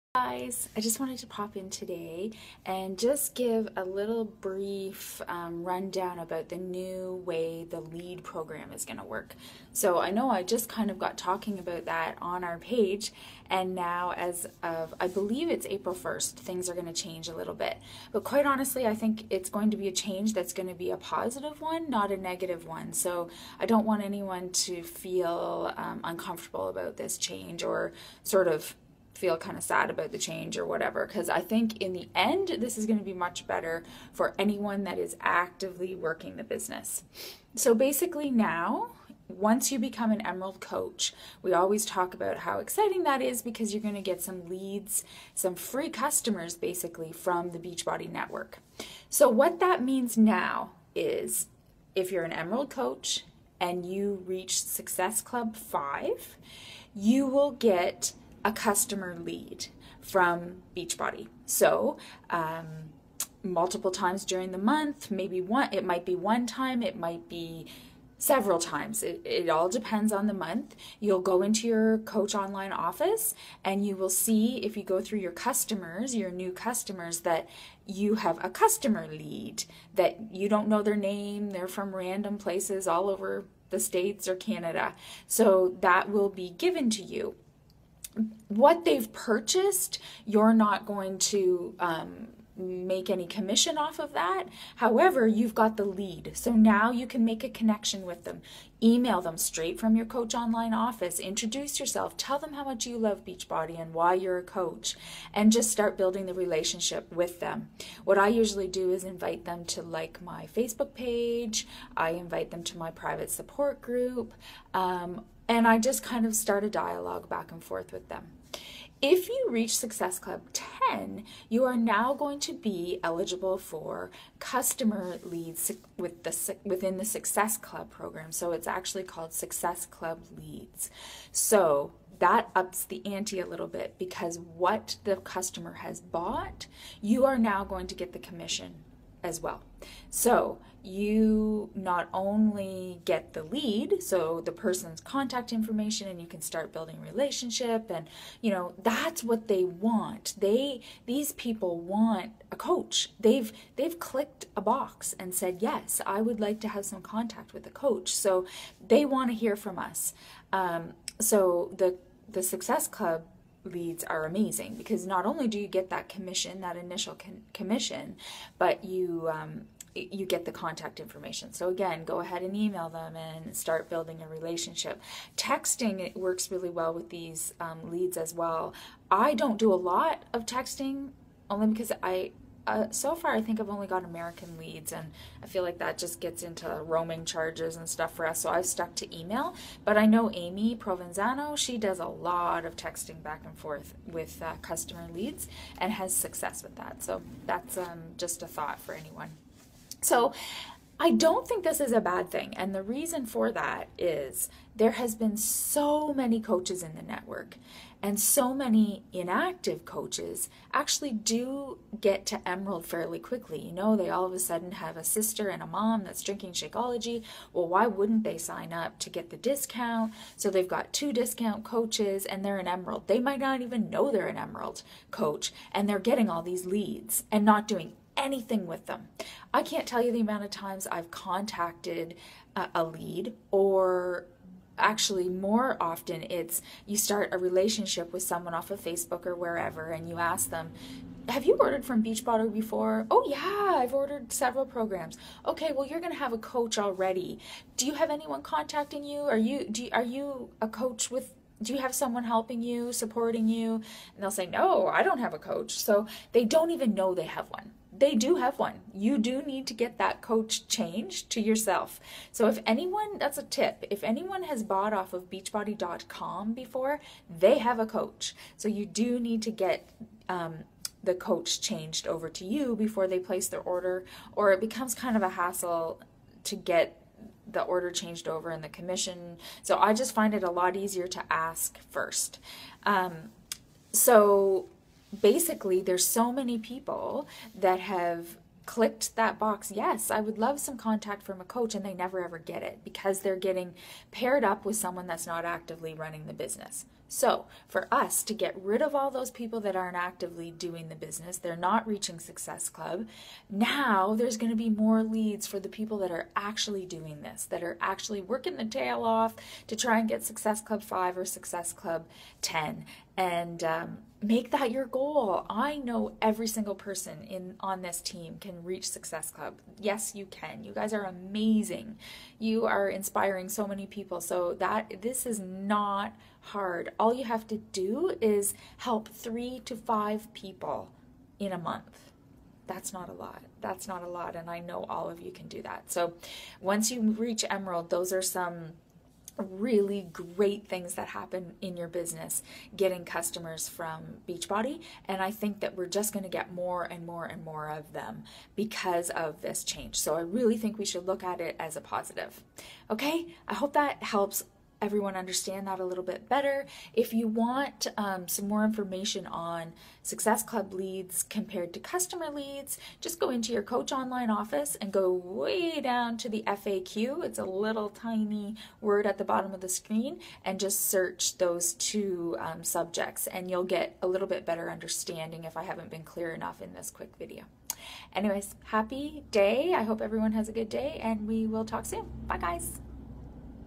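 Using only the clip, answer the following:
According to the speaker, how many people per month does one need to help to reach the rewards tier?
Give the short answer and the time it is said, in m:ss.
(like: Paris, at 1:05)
3 to 5, at 5:29.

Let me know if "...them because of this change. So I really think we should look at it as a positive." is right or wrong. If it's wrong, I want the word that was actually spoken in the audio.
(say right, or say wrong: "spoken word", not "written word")
right.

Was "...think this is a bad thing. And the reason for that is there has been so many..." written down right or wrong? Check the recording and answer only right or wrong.
right.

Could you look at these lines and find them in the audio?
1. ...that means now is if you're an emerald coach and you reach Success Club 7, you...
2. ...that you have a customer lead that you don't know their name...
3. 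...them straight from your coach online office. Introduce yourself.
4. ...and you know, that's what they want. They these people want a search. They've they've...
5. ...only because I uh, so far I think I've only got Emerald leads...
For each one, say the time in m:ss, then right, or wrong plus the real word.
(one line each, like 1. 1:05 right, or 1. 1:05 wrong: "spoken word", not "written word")
1. 0:49 wrong: "5", not "7"
2. 1:17 right
3. 1:39 right
4. 2:27 wrong: "coach", not "search"
5. 3:01 wrong: "American", not "Emerald".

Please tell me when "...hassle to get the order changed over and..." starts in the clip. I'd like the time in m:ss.
4:35.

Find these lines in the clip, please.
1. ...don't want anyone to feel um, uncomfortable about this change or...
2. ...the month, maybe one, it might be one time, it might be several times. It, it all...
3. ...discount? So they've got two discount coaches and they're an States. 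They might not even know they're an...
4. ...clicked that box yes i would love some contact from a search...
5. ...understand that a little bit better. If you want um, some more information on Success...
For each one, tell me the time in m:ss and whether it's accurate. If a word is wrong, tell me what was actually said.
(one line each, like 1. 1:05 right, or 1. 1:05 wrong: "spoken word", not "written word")
1. 0:23 right
2. 1:04 right
3. 3:39 wrong: "Emerald", not "States"
4. 4:48 wrong: "coach", not "search"
5. 5:55 right.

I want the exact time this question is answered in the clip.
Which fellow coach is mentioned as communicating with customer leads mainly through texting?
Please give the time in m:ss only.
3:10.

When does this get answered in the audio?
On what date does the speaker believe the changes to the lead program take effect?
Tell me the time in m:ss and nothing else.
0:15.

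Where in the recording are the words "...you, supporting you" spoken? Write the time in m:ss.
4:12.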